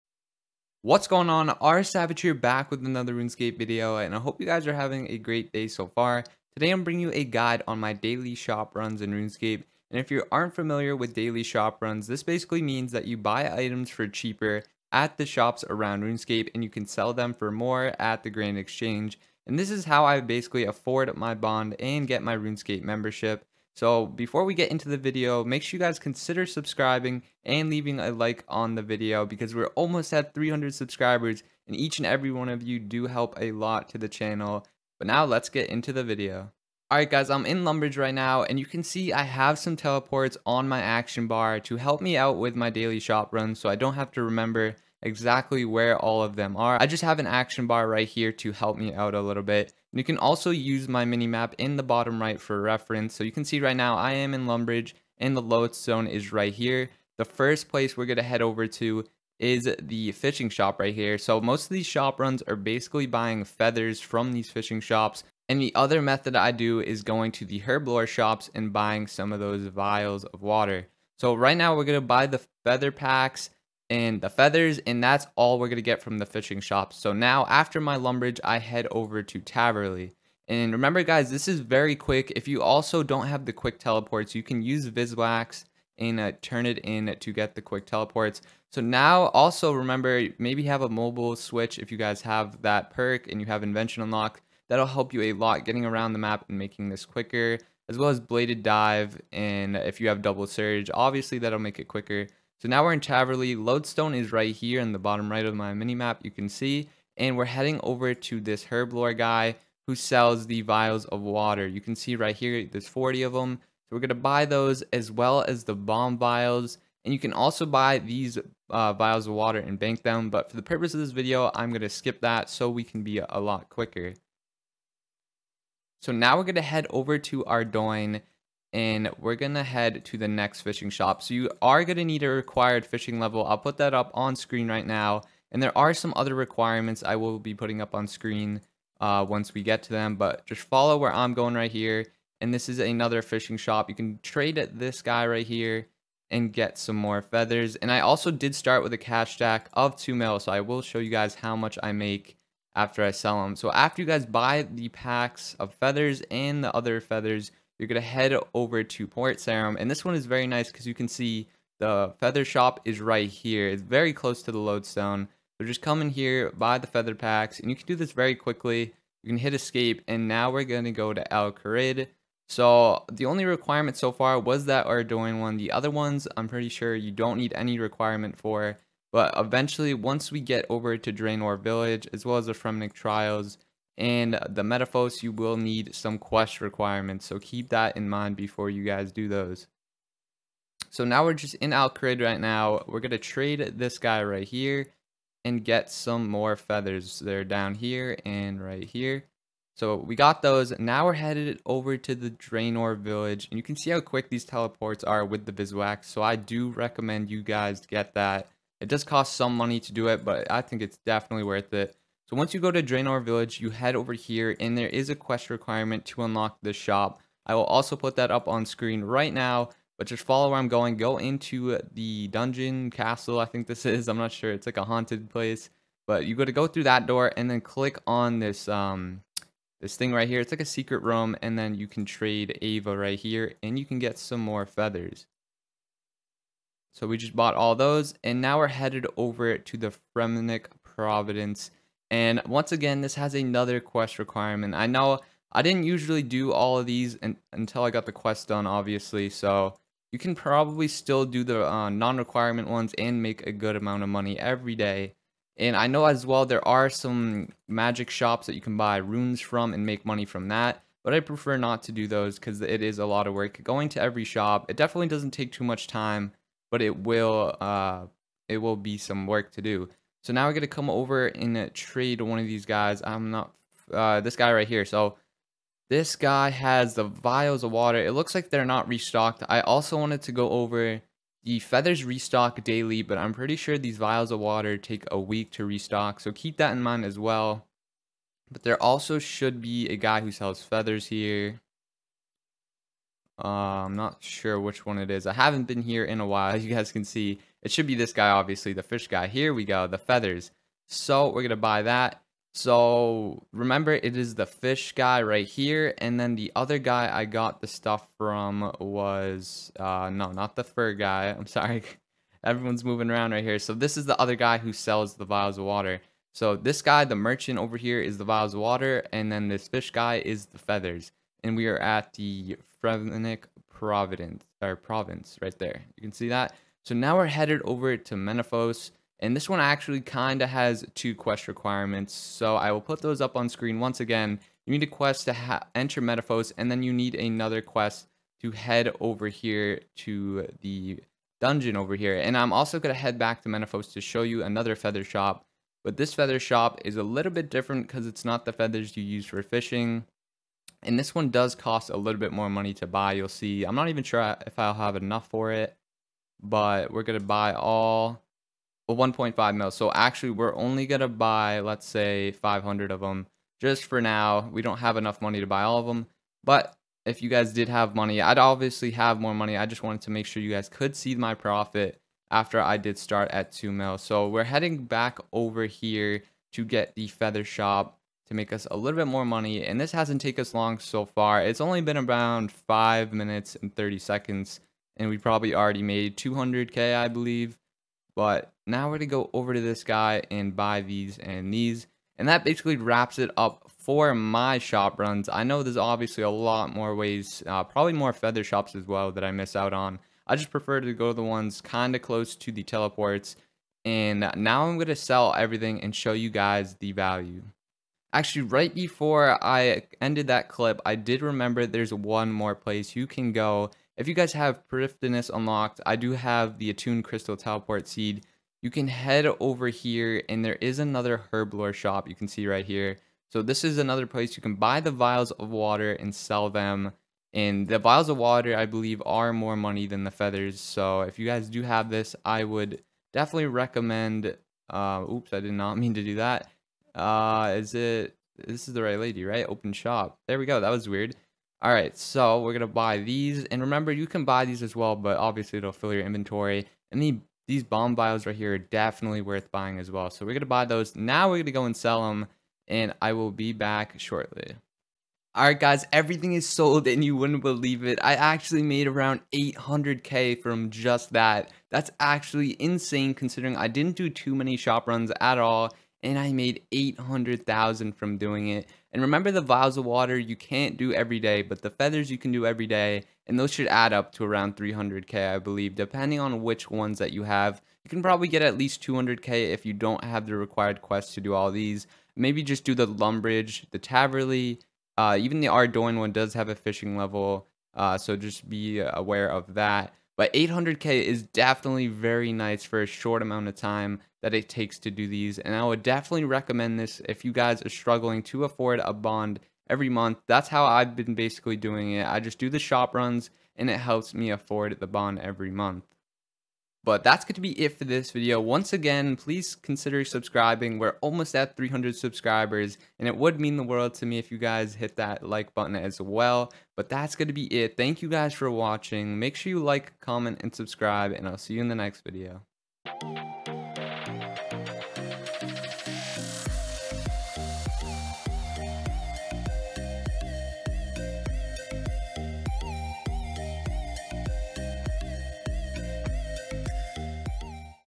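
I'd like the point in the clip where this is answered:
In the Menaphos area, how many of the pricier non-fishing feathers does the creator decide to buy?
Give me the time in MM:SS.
06:02.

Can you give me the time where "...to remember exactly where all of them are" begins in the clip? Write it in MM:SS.
00:44.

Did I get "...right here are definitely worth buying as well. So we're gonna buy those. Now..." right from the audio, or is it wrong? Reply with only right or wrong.
right.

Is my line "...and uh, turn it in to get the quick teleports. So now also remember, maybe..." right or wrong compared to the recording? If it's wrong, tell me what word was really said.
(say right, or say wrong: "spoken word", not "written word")
right.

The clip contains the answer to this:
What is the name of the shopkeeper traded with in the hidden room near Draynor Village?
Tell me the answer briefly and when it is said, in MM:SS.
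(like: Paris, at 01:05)
Ava, at 03:52.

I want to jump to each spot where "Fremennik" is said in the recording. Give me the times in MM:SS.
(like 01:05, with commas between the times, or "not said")
03:02, 04:00, 05:22.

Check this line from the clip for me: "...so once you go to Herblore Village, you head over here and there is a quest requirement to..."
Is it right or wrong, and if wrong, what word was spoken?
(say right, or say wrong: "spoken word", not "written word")
wrong: "Draynor", not "Herblore".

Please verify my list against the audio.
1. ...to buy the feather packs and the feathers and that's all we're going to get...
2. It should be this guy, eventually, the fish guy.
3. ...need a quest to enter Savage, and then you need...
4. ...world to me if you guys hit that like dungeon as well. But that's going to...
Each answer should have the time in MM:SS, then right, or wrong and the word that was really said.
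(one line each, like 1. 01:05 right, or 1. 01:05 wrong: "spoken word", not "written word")
1. 01:12 right
2. 04:57 wrong: "obviously", not "eventually"
3. 05:34 wrong: "Menaphos", not "Savage"
4. 08:33 wrong: "button", not "dungeon".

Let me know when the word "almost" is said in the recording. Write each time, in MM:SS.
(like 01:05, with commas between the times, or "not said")
00:29, 08:31.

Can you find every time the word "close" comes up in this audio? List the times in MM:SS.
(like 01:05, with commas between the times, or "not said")
02:44, 06:42.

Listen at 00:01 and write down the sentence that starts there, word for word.
R Savage here back with another RuneScape video and I hope you guys are having a great day so far.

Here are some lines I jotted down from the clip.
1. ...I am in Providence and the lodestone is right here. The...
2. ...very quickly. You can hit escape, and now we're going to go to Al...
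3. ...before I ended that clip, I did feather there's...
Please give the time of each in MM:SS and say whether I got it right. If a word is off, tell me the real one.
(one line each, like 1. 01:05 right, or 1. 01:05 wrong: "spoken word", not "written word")
1. 00:53 wrong: "Lumbridge", not "Providence"
2. 02:48 right
3. 06:48 wrong: "remember", not "feather".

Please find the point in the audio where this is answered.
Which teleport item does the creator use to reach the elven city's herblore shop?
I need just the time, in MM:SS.
06:56.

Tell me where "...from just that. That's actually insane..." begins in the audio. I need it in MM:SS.
07:40.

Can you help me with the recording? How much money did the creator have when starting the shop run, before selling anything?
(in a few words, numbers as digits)
2 million.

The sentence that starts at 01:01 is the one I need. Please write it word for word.
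So most of these shop runs are basically buying feathers from these fishing shops.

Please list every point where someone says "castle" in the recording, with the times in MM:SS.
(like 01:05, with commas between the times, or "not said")
03:42.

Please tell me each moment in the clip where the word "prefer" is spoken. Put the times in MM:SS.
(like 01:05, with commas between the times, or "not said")
04:21, 06:40.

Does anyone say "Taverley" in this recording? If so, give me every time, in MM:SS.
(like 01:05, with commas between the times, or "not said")
01:19, 01:42, 08:03.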